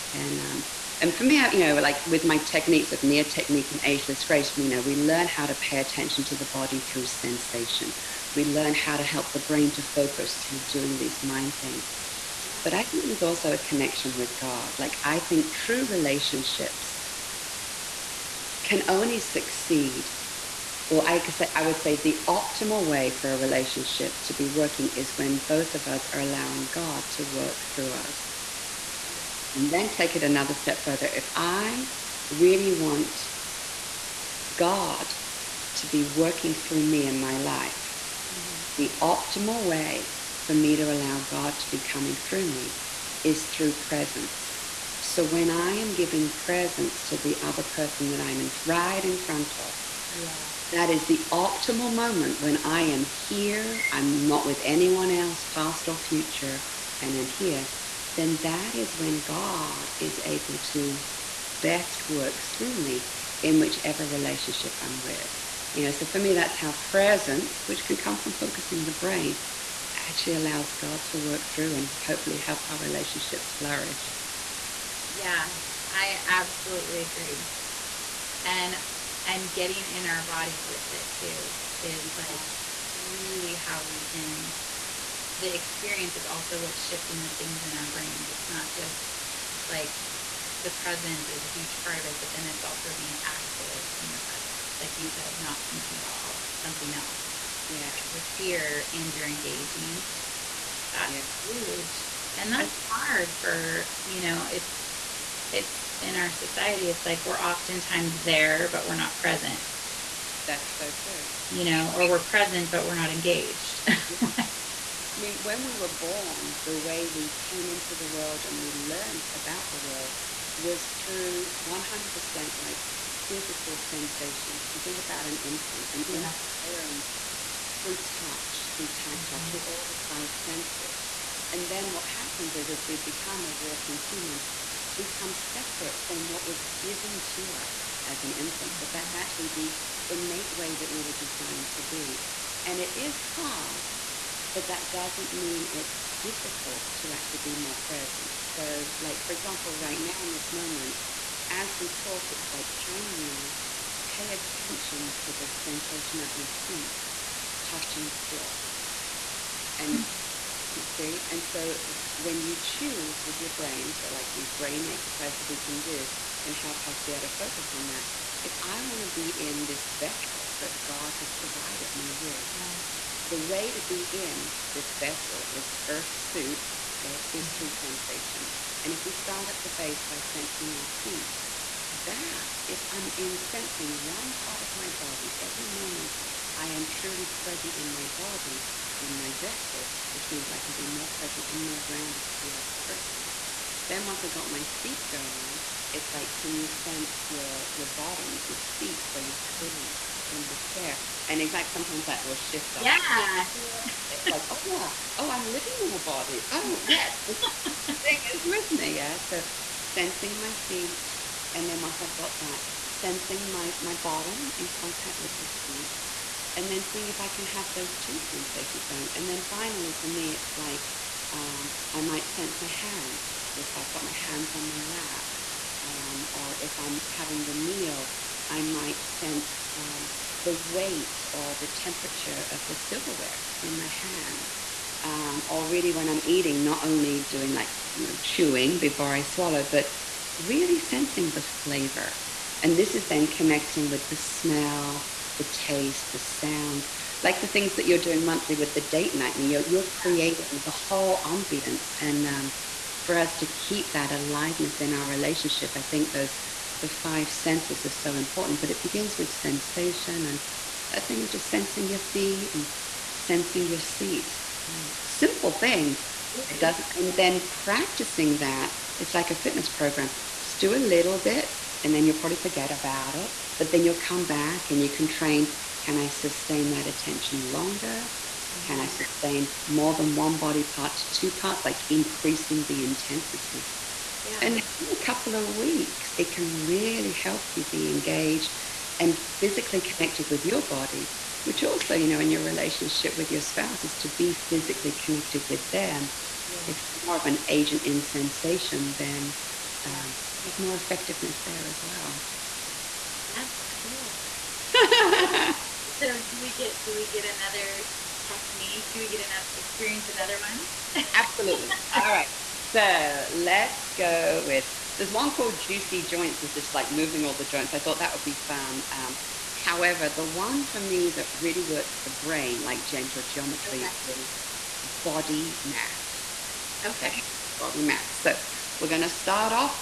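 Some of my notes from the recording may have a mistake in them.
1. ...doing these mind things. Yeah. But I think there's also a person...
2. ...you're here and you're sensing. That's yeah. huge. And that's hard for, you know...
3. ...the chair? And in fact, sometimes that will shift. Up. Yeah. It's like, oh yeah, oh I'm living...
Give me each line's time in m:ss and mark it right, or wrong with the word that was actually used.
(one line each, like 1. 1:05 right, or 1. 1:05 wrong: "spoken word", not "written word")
1. 0:10 wrong: "connection", not "person"
2. 1:38 wrong: "engaging", not "sensing"
3. 3:20 right.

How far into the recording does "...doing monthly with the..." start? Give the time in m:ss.
4:08.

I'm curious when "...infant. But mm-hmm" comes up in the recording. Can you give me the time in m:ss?
2:18.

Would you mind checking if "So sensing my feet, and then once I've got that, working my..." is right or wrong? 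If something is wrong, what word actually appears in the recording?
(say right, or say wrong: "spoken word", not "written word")
wrong: "sensing", not "working".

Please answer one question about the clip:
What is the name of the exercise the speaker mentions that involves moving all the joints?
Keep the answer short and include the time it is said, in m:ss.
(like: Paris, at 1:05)
Juicy Joints, at 5:15.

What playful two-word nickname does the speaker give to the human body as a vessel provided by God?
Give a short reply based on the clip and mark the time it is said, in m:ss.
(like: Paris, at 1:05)
earth suit, at 2:55.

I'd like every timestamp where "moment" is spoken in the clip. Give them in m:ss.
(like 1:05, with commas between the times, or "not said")
0:51, 2:30, 3:05.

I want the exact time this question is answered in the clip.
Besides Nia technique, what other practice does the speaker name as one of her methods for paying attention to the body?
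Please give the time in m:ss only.
0:03.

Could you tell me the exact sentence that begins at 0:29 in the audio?
Yeah and then take it another step further.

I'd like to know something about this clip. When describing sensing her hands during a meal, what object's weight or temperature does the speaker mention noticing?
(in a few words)
silverware.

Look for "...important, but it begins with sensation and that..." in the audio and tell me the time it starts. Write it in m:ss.
4:18.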